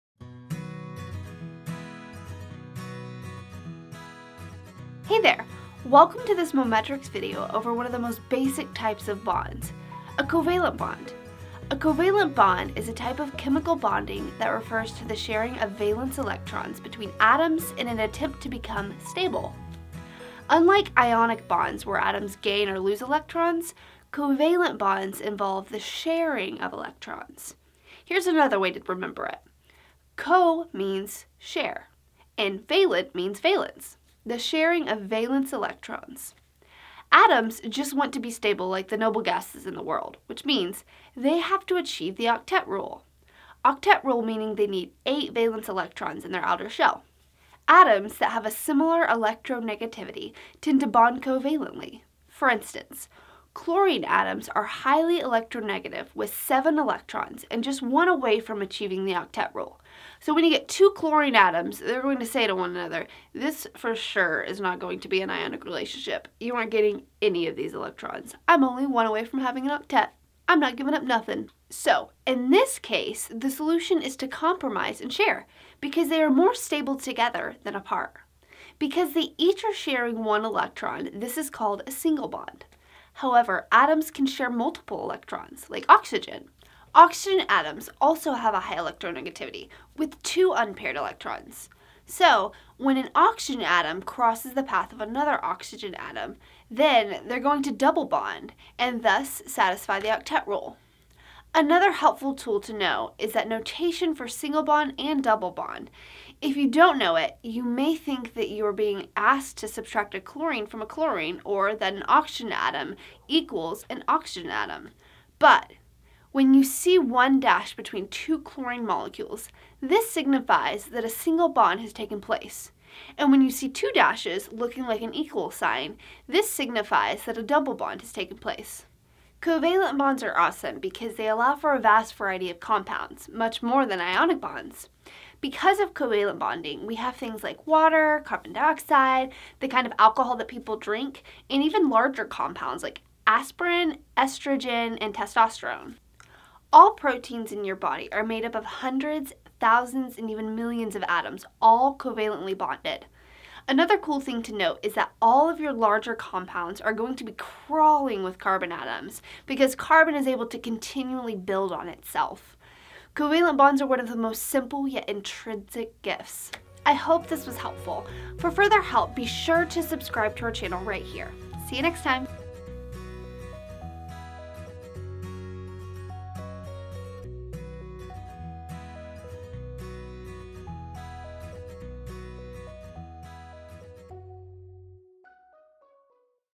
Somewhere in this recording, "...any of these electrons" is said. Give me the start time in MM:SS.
01:07.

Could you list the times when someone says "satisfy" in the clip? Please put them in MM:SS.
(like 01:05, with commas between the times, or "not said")
01:39.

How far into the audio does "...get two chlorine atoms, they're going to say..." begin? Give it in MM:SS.
01:00.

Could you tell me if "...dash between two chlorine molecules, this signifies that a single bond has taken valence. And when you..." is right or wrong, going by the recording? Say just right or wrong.
wrong.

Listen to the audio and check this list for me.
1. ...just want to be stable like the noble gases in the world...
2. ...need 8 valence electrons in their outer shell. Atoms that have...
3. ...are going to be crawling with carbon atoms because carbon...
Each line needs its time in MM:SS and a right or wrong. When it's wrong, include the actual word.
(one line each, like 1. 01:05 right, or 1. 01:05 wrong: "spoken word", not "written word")
1. 00:37 right
2. 00:44 right
3. 02:36 right.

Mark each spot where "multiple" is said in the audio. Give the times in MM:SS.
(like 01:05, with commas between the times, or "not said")
01:24.